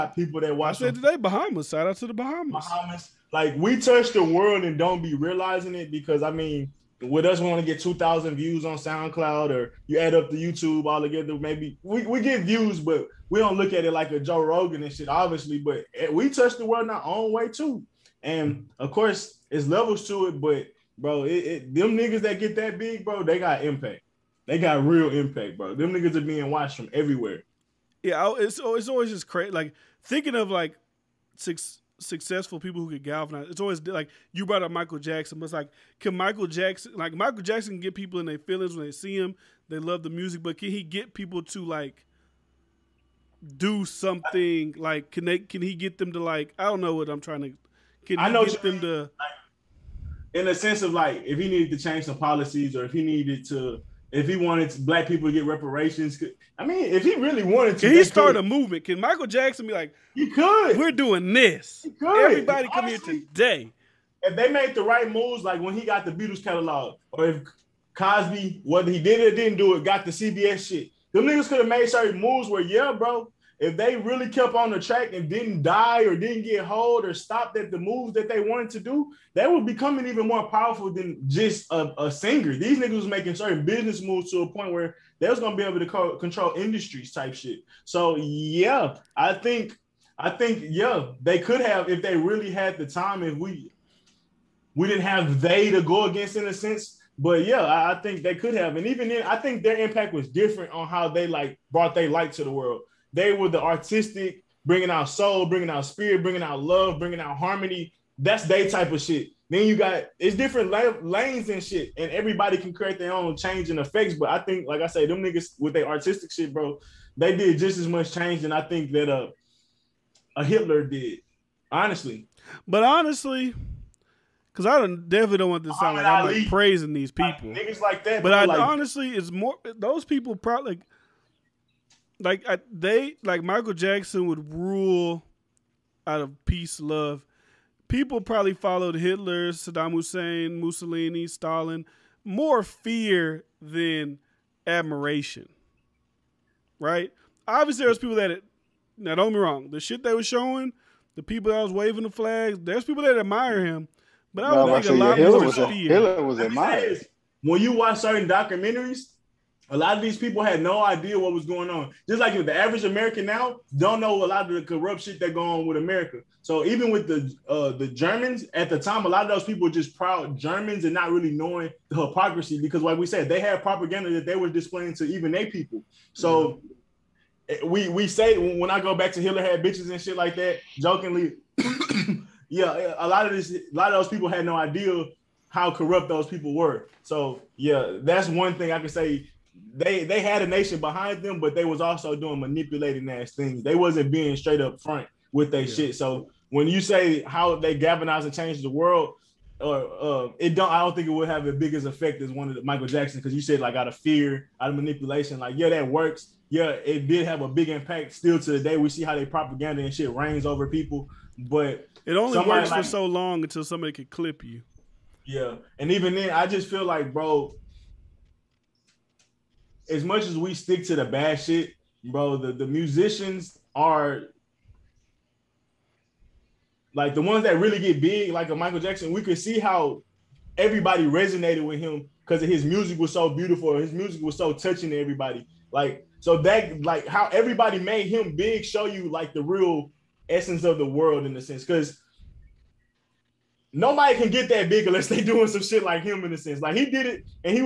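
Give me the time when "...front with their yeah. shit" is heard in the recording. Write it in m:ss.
3:14.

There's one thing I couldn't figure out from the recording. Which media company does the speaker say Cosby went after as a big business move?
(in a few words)
CBS.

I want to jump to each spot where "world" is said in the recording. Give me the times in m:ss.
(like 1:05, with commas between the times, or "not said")
0:04, 0:16, 1:42, 3:18, 4:00.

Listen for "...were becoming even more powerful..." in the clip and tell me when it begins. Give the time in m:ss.
1:19.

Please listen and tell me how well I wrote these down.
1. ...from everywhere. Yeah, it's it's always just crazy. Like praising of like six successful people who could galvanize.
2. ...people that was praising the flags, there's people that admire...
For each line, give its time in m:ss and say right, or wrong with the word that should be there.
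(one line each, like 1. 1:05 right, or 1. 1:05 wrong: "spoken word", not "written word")
1. 0:26 wrong: "thinking", not "praising"
2. 2:31 wrong: "waving", not "praising".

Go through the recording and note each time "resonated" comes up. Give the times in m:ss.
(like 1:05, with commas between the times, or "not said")
3:51.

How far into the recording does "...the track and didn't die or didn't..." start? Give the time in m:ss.
1:14.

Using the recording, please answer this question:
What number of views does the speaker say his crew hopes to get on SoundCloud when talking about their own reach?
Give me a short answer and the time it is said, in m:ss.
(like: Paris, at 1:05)
2,000, at 0:07.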